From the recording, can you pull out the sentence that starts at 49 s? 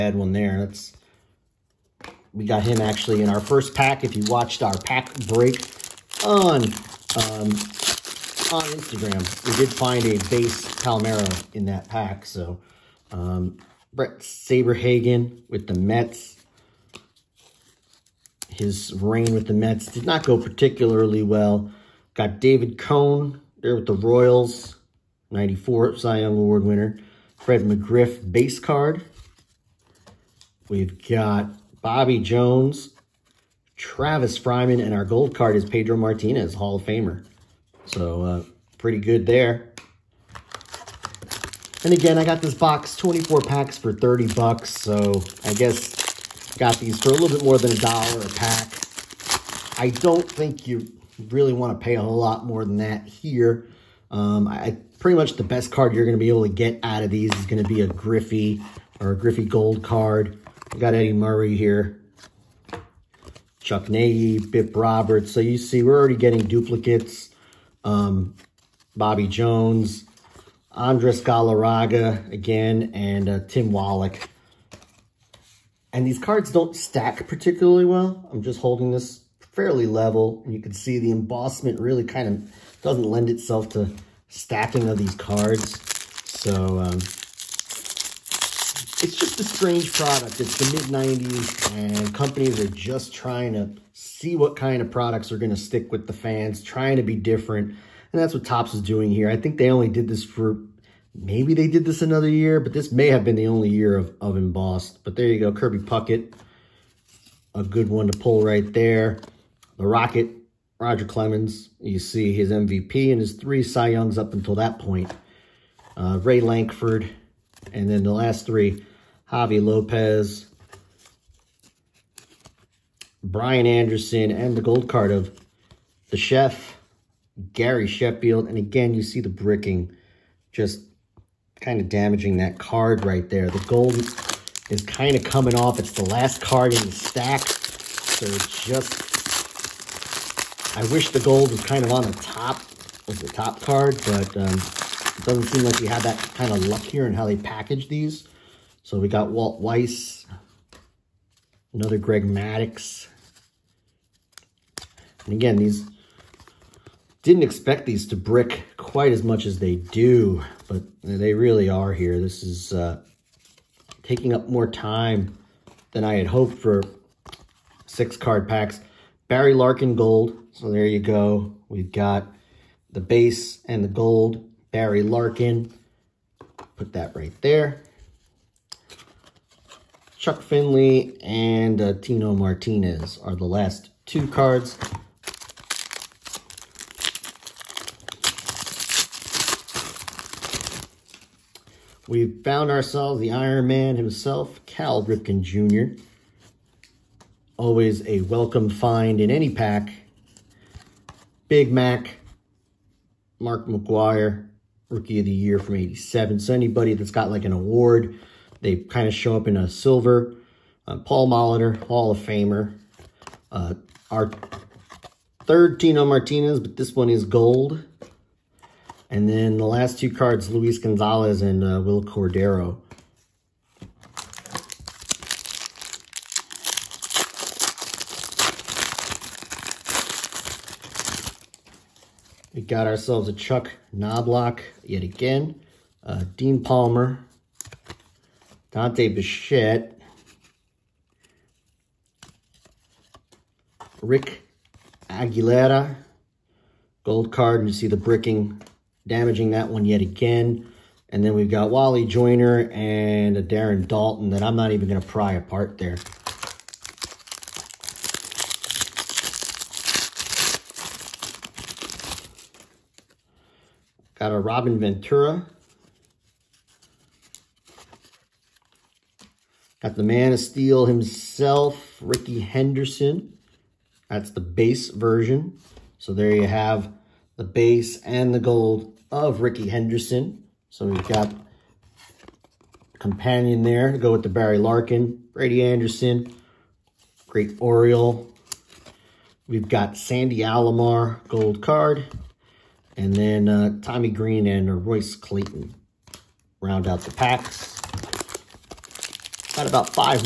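I don't think you really want to pay a lot more than that here.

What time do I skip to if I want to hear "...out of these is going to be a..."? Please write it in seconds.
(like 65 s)
56 s.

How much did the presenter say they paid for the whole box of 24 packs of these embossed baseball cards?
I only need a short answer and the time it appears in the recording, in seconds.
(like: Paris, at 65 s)
$30, at 43 s.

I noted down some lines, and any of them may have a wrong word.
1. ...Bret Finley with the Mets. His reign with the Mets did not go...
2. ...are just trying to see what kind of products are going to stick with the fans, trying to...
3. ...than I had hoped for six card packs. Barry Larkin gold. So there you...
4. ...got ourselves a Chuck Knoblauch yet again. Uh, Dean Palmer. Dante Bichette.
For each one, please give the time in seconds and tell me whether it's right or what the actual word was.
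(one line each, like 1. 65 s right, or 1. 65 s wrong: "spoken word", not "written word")
1. 13 s wrong: "Saberhagen", not "Finley"
2. 92 s right
3. 165 s right
4. 232 s right.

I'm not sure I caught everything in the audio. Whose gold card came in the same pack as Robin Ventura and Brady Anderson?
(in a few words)
Sandy Alomar.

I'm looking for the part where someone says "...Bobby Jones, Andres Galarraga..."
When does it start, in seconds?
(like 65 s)
68 s.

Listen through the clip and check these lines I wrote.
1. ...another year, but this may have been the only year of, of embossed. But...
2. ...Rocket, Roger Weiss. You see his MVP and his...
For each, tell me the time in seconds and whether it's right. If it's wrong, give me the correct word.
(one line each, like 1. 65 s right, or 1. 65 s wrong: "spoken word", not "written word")
1. 102 s right
2. 109 s wrong: "Clemens", not "Weiss".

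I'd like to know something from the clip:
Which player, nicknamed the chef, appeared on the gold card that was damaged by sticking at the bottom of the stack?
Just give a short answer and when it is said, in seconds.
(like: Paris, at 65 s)
Gary Sheffield, at 127 s.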